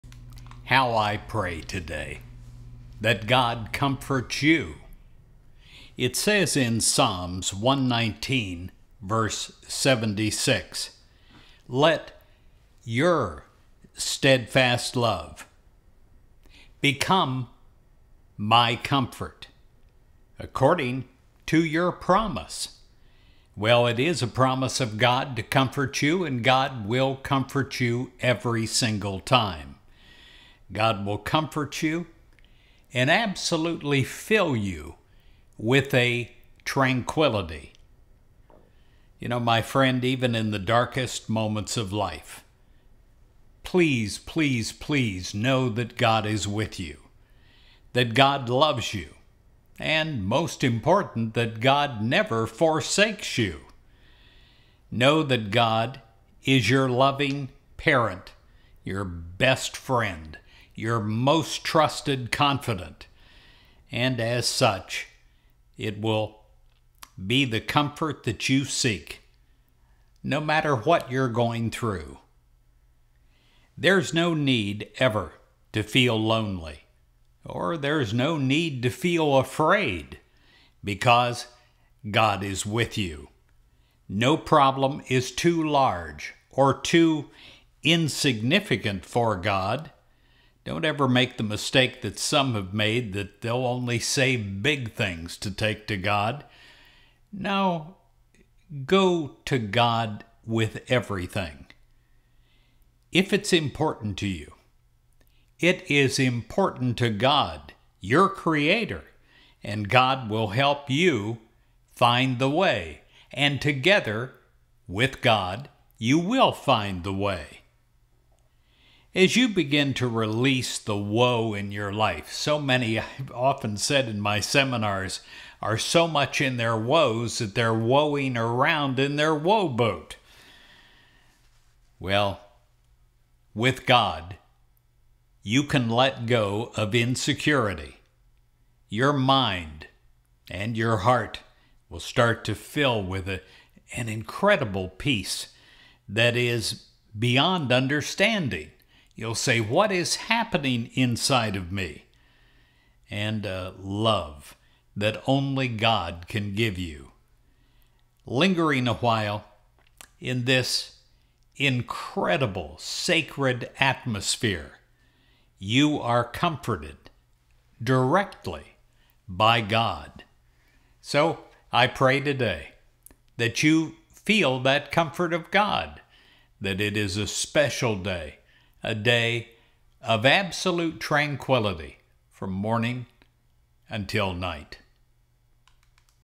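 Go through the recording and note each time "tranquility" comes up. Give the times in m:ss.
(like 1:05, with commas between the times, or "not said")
0:36, 3:00.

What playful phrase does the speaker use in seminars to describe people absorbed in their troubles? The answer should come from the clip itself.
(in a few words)
woe boat.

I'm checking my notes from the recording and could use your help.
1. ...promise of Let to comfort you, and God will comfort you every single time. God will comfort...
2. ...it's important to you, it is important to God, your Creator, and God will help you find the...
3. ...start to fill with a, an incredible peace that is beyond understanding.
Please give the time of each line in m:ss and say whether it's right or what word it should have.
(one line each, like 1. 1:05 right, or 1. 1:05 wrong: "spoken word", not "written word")
1. 0:24 wrong: "God", not "Let"
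2. 1:43 right
3. 2:21 right.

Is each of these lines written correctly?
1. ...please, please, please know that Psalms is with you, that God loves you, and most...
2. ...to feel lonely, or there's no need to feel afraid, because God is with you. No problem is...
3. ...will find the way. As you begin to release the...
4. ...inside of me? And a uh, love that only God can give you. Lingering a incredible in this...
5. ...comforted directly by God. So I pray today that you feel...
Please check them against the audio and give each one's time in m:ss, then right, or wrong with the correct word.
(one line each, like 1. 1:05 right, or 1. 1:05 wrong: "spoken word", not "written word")
1. 0:43 wrong: "God", not "Psalms"
2. 1:15 right
3. 1:56 right
4. 2:30 wrong: "while", not "incredible"
5. 2:46 right.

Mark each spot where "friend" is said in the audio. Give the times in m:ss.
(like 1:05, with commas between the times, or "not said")
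0:39, 0:59.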